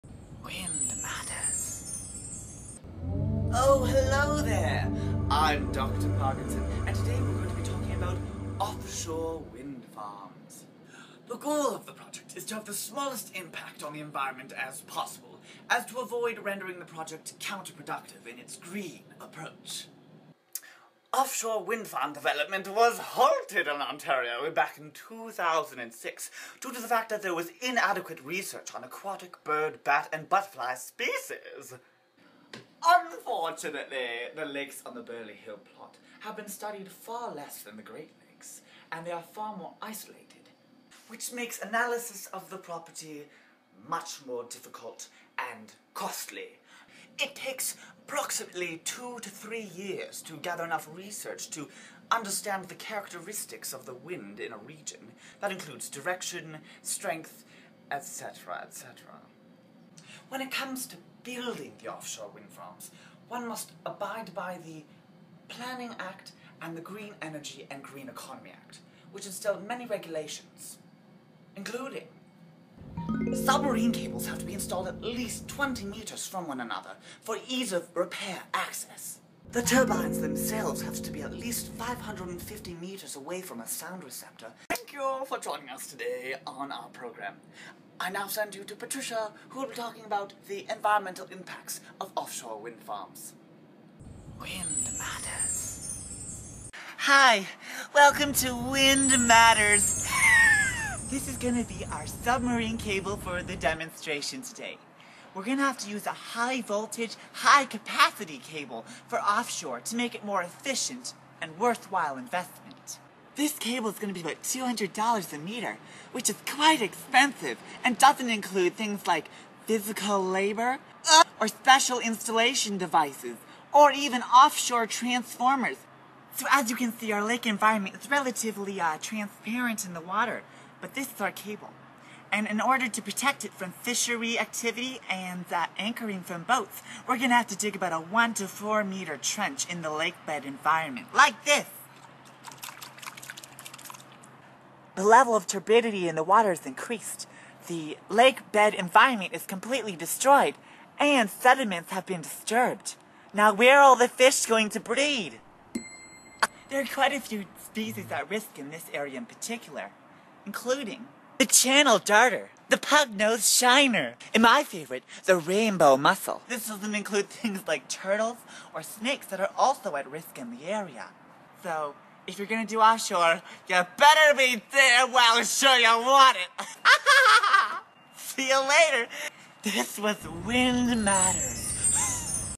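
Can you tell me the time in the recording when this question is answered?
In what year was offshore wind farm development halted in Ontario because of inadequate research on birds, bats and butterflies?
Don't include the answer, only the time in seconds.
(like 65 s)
24 s.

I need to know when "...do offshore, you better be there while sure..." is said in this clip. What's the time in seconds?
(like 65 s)
172 s.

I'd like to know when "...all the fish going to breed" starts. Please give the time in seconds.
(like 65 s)
153 s.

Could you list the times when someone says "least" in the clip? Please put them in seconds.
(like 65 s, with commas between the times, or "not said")
75 s, 81 s.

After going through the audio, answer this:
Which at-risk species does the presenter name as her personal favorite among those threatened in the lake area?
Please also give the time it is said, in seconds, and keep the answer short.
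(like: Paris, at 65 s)
Rainbow mussel, at 165 s.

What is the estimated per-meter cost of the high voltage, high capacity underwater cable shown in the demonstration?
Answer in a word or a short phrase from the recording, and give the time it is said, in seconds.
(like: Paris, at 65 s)
$200 a meter, at 114 s.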